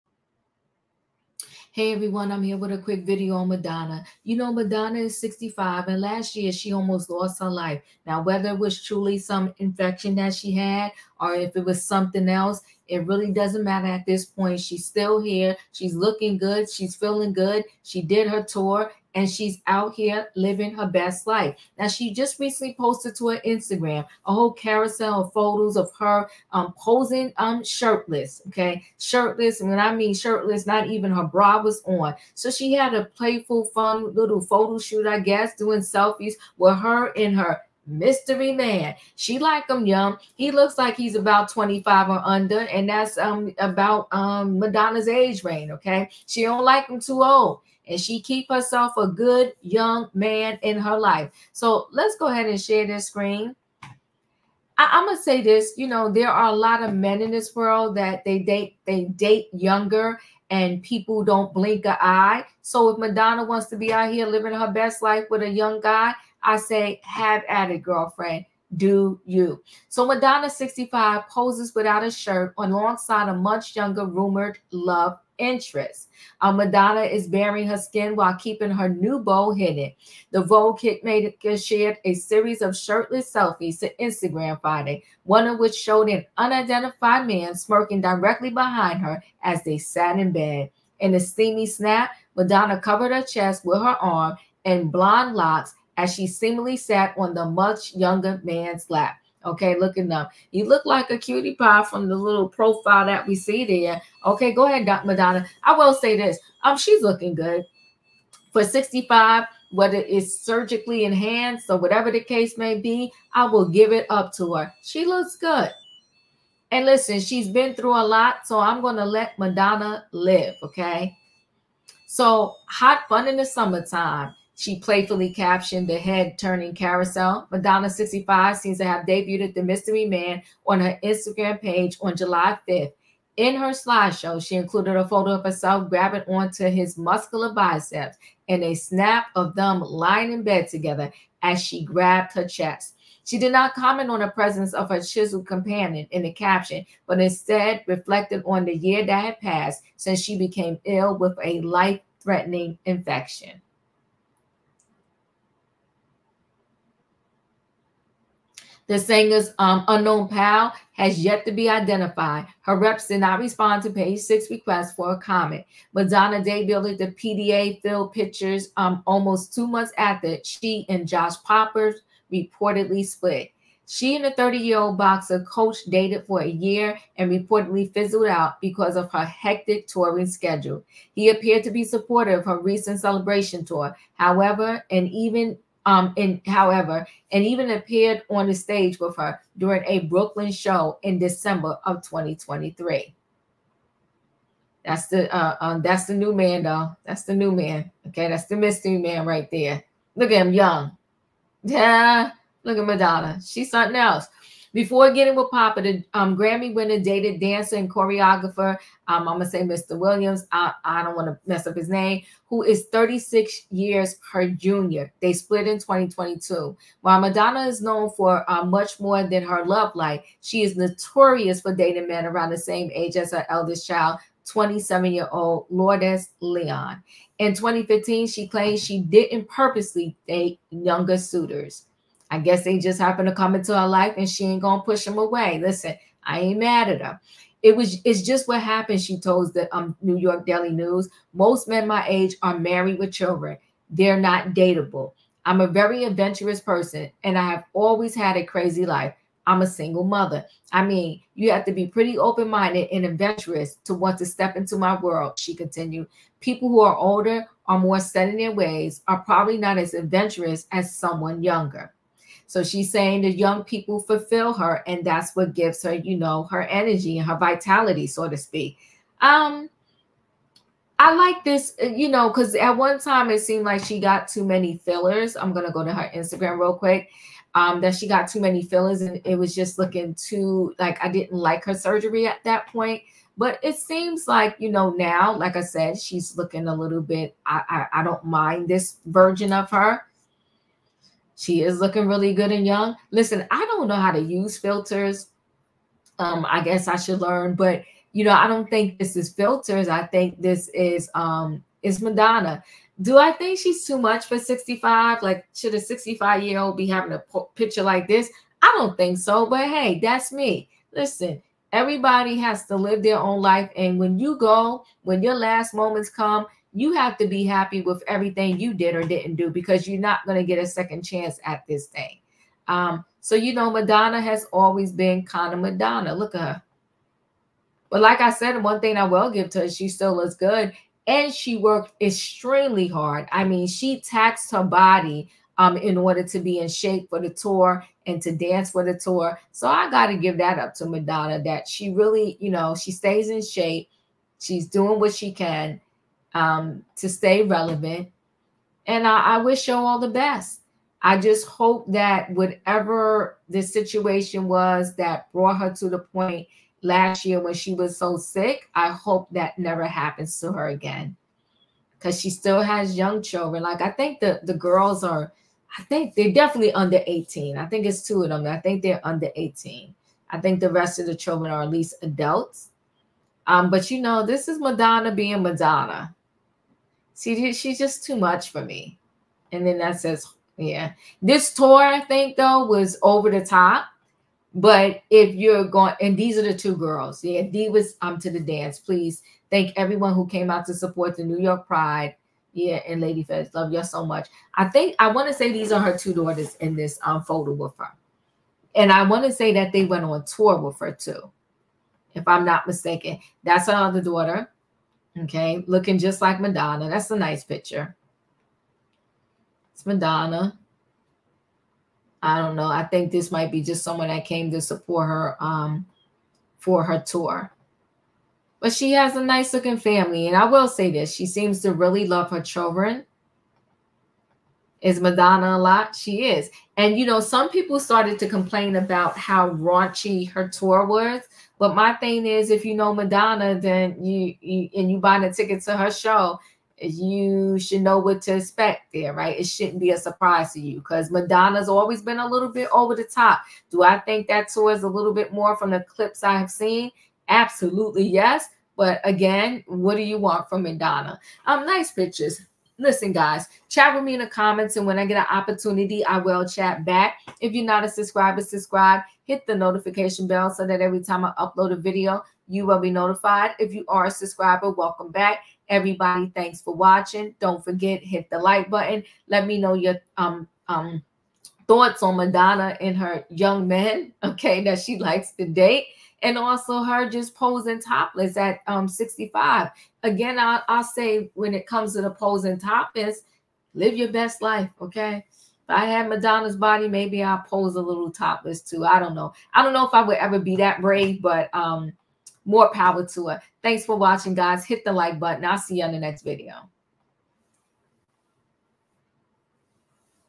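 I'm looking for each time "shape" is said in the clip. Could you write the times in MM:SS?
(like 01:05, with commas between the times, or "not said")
05:36, 05:43.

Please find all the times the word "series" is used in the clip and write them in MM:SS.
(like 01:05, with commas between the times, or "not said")
01:22.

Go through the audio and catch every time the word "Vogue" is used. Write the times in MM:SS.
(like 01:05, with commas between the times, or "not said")
01:20.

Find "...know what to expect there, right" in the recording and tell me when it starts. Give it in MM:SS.
07:17.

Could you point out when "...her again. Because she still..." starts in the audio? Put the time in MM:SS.
06:00.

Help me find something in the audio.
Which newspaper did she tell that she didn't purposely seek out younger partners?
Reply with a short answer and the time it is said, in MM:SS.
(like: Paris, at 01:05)
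New York Daily News, at 04:00.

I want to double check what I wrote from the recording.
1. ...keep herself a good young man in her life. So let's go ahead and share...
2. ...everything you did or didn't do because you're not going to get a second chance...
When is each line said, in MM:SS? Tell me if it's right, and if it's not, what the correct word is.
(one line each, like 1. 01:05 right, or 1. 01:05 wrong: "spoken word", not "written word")
1. 00:48 right
2. 05:18 right.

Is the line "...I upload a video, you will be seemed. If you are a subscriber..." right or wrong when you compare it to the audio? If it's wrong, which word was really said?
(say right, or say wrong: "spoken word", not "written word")
wrong: "notified", not "seemed".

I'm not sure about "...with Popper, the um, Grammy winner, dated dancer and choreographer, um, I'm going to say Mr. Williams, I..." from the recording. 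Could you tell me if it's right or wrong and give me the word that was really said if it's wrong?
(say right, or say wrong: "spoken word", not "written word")
right.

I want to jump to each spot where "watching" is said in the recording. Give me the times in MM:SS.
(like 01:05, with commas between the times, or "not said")
07:46, 08:13.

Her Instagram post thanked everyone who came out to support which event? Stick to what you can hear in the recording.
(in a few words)
New York Pride.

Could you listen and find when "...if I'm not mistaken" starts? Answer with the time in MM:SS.
06:42.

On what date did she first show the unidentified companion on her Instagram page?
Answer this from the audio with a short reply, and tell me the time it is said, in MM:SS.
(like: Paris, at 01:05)
July 5th, at 02:12.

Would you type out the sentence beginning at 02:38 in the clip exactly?
The singer's um, unknown pal has yet to be identified.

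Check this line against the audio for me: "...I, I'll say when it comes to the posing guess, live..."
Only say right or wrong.
wrong.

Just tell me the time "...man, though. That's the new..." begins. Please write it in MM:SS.
03:16.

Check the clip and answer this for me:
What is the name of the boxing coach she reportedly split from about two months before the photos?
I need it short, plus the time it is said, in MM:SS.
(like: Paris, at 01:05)
Josh Popper, at 02:51.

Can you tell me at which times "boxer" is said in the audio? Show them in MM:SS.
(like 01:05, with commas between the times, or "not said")
02:54.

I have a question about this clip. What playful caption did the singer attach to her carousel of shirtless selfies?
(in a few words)
Hot fun in the summertime.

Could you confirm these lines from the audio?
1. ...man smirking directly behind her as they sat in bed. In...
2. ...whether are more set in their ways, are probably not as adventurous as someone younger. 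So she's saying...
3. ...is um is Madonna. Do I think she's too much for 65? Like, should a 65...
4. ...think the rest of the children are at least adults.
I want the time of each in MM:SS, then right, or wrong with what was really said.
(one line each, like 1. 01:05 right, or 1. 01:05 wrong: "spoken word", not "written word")
1. 01:27 right
2. 04:16 wrong: "older", not "whether"
3. 05:00 right
4. 06:10 right.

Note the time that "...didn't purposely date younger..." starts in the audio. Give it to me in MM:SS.
03:49.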